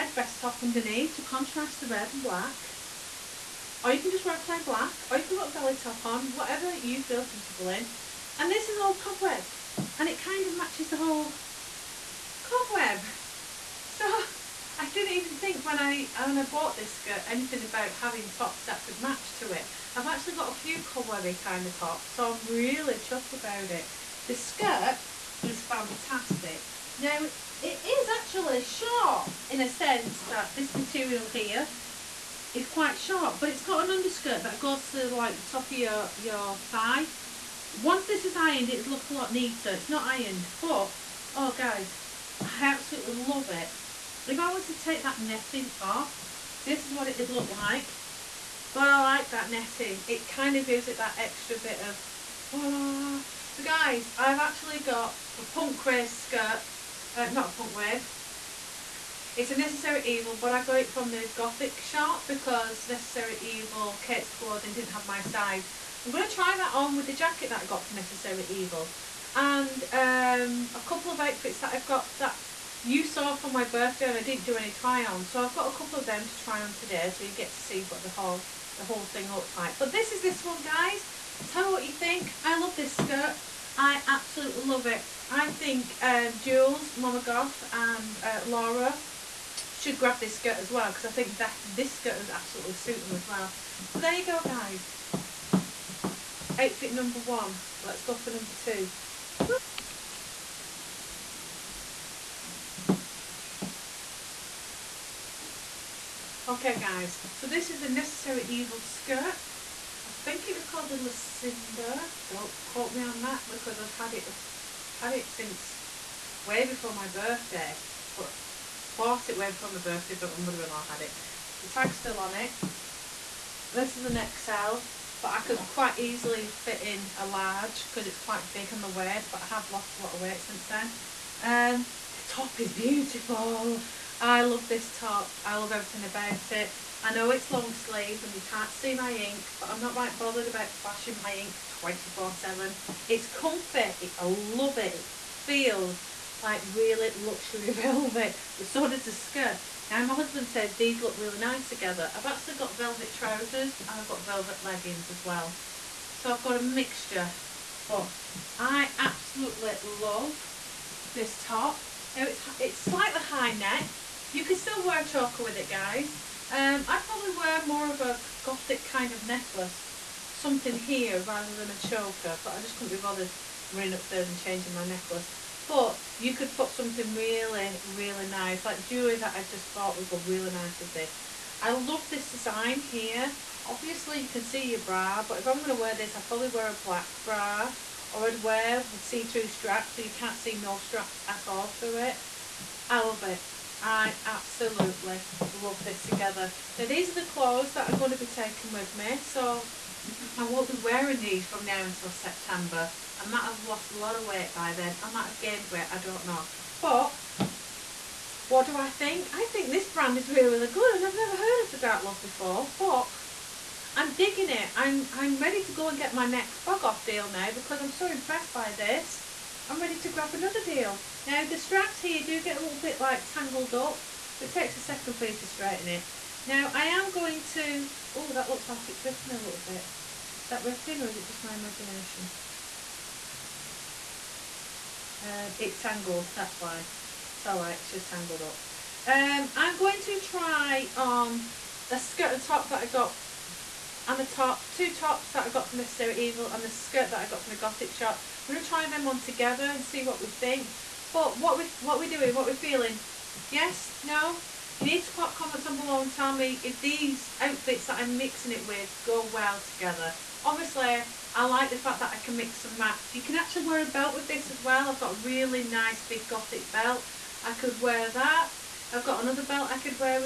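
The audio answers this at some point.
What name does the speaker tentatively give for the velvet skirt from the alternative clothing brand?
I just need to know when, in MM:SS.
01:50.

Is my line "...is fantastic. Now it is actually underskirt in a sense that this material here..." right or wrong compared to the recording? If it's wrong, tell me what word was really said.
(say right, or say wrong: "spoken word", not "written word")
wrong: "short", not "underskirt".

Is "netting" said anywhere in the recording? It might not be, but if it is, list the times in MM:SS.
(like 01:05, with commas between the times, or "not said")
00:45, 00:49.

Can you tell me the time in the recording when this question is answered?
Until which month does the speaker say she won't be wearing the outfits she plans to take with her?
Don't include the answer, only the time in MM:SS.
03:22.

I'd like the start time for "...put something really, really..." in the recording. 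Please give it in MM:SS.
02:56.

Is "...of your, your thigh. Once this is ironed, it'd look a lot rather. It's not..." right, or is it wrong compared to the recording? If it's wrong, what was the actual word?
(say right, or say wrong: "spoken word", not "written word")
wrong: "neater", not "rather".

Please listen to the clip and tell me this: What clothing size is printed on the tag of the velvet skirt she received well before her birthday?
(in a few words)
XL.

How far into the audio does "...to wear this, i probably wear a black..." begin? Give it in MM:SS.
03:05.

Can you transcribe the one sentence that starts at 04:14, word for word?
You need to pop comments on below and tell me if these outfits that I'm mixing it with go well together.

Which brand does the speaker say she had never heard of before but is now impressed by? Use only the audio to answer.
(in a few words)
Dark Love.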